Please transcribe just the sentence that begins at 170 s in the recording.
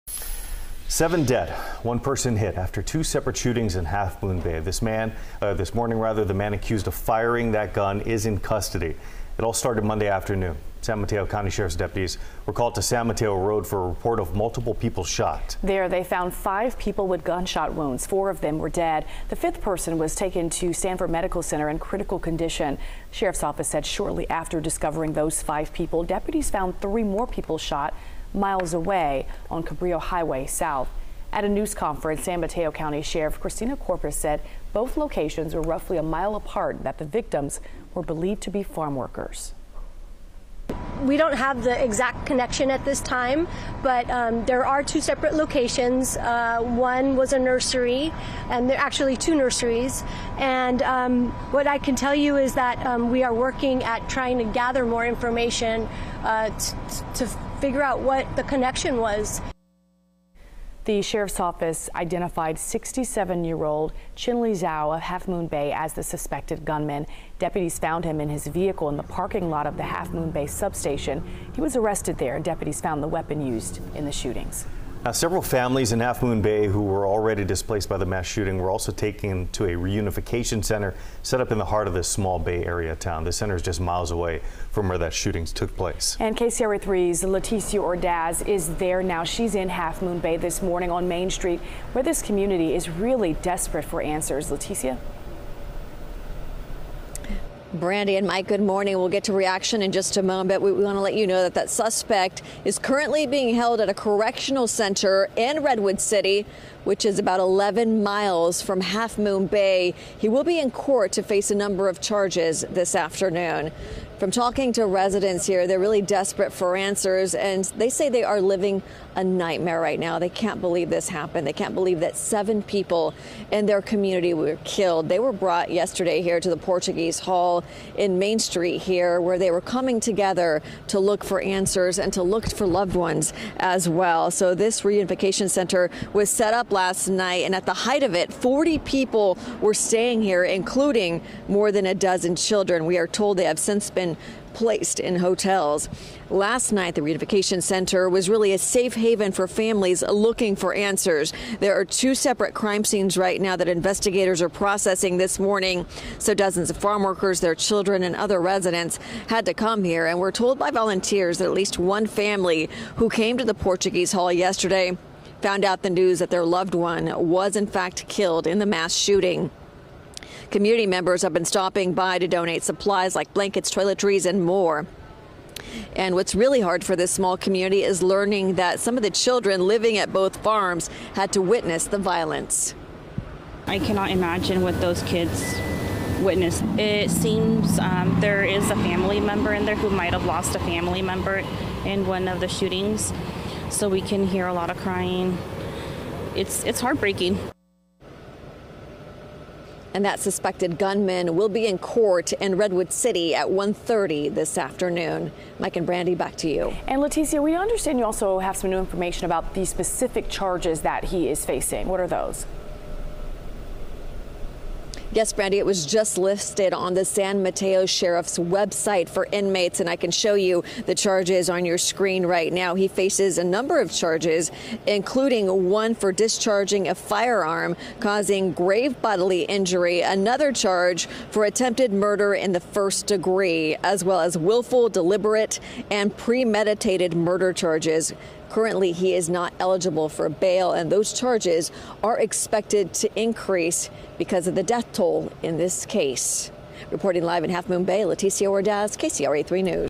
Community members have been stopping by to donate supplies like blankets, toiletries, and more.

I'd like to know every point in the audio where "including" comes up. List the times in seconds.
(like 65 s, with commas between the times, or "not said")
140 s, 224 s.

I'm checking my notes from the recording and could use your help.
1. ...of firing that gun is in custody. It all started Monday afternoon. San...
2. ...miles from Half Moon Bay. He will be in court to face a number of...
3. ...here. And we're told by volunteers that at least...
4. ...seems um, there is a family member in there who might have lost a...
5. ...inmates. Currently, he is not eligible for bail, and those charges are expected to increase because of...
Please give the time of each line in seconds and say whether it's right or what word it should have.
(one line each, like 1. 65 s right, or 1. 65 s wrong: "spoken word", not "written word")
1. 6 s right
2. 108 s right
3. 159 s right
4. 187 s right
5. 237 s wrong: "charges", not "inmates".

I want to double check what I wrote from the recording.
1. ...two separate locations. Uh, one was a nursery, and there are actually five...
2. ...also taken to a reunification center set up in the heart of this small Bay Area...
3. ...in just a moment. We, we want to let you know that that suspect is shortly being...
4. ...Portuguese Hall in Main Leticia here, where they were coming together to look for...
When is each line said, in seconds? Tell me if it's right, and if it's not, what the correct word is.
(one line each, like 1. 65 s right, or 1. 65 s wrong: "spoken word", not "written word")
1. 44 s wrong: "two", not "five"
2. 78 s right
3. 99 s wrong: "currently", not "shortly"
4. 126 s wrong: "Street", not "Leticia".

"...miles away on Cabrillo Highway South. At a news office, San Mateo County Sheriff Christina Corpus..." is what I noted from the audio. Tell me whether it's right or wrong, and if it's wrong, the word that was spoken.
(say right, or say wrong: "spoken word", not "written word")
wrong: "conference", not "office".